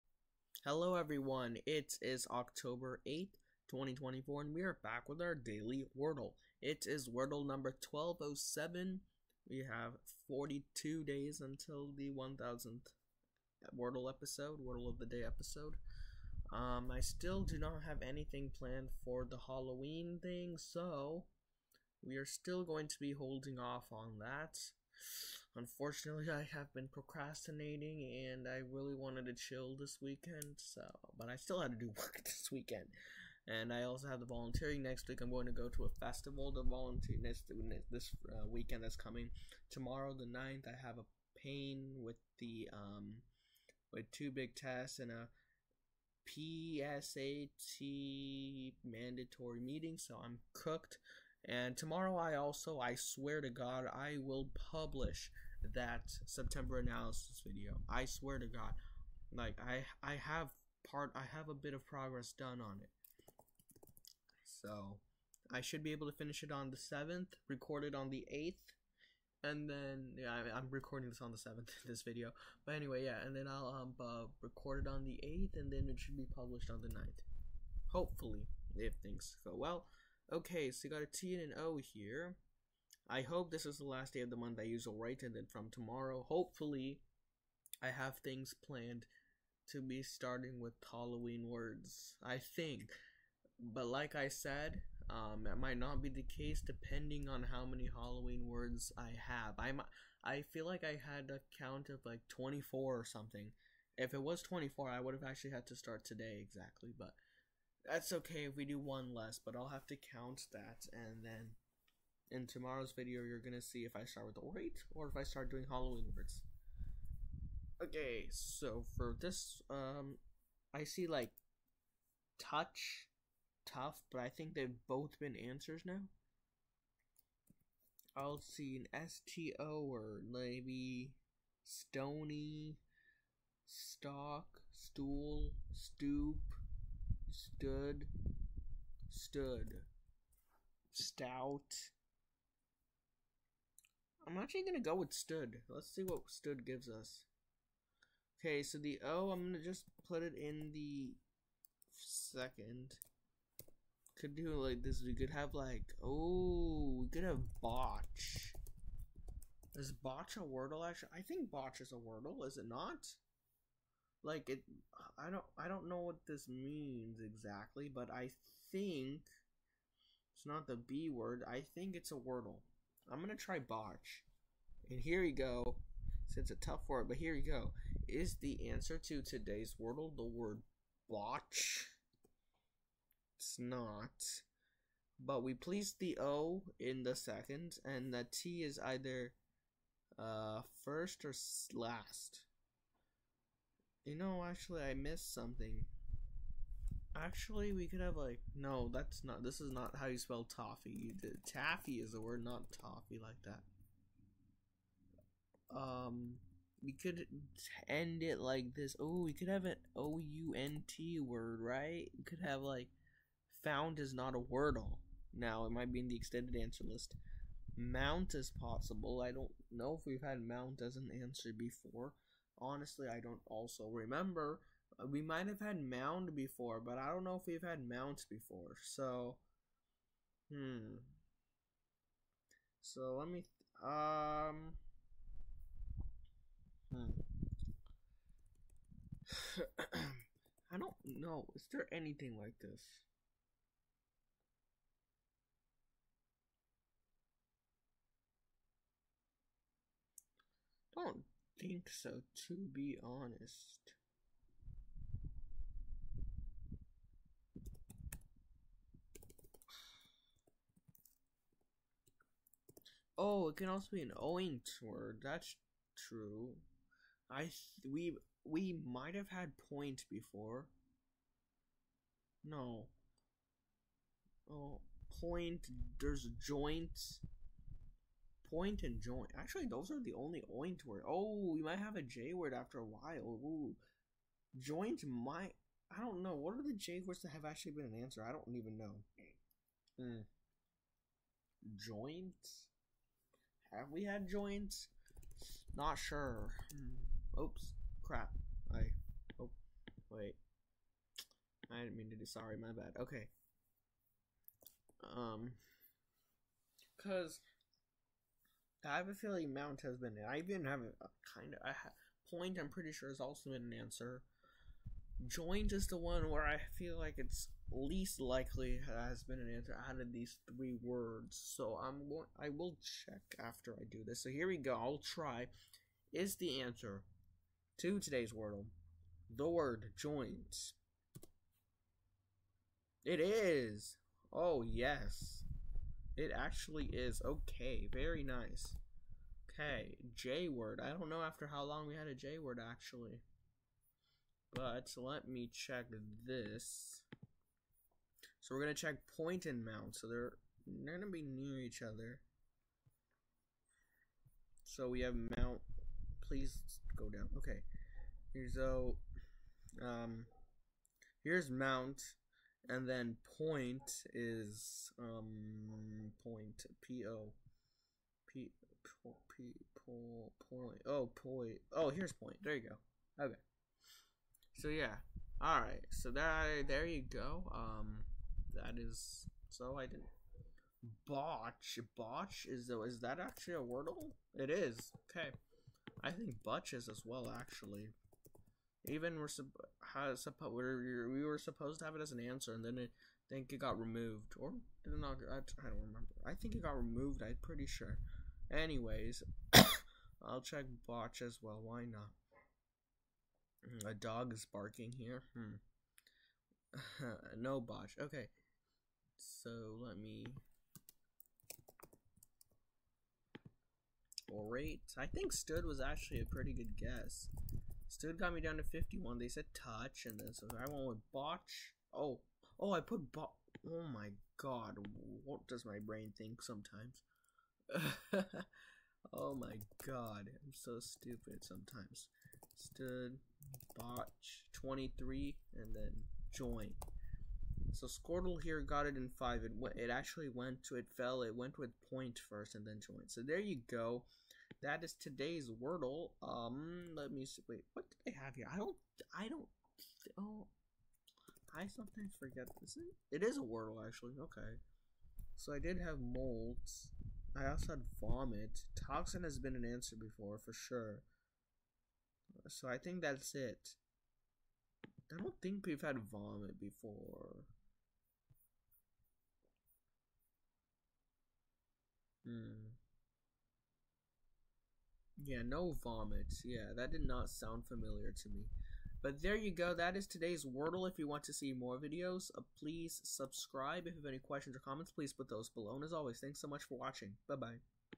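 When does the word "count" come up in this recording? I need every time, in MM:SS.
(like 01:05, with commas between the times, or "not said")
01:41, 01:49.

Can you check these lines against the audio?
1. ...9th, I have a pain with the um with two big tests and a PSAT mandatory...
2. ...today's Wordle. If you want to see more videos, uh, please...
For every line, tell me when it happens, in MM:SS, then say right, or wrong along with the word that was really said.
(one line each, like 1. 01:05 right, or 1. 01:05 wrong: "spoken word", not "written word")
1. 00:40 right
2. 08:00 right.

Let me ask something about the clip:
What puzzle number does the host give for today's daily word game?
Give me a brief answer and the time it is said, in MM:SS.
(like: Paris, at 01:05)
1207, at 00:07.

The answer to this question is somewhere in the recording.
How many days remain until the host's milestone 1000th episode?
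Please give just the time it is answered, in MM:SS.
00:10.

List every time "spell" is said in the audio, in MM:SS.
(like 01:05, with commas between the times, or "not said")
03:20.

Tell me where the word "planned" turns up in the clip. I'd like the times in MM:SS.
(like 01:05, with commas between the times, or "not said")
00:18, 01:28.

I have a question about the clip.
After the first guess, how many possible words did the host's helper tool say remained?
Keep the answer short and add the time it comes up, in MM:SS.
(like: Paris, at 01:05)
51, at 06:58.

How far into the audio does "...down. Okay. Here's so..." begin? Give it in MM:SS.
05:57.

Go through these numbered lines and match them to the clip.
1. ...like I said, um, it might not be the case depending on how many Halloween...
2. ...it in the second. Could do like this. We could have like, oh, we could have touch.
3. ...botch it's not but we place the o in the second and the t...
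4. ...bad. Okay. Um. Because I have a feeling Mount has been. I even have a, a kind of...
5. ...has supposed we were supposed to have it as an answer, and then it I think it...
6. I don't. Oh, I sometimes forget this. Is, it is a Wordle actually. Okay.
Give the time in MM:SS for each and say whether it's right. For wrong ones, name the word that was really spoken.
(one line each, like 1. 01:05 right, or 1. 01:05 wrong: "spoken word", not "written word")
1. 01:33 right
2. 02:30 wrong: "botch", not "touch"
3. 03:01 right
4. 05:02 right
5. 06:29 right
6. 07:29 right.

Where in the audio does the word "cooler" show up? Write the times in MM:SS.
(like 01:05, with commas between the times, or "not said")
not said.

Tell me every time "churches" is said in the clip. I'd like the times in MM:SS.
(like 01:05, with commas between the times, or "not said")
not said.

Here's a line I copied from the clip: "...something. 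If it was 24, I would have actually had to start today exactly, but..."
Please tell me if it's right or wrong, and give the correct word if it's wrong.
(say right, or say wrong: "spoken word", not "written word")
right.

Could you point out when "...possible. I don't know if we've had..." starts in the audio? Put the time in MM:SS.
03:38.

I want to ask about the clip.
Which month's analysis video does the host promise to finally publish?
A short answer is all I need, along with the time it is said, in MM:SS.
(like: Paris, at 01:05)
September, at 00:56.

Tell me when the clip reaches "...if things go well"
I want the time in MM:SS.
01:18.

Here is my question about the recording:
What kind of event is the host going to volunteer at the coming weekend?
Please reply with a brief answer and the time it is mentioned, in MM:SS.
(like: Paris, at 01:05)
A festival, at 00:36.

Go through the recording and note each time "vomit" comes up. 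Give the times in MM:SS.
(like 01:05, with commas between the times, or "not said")
07:37, 07:46, 07:55.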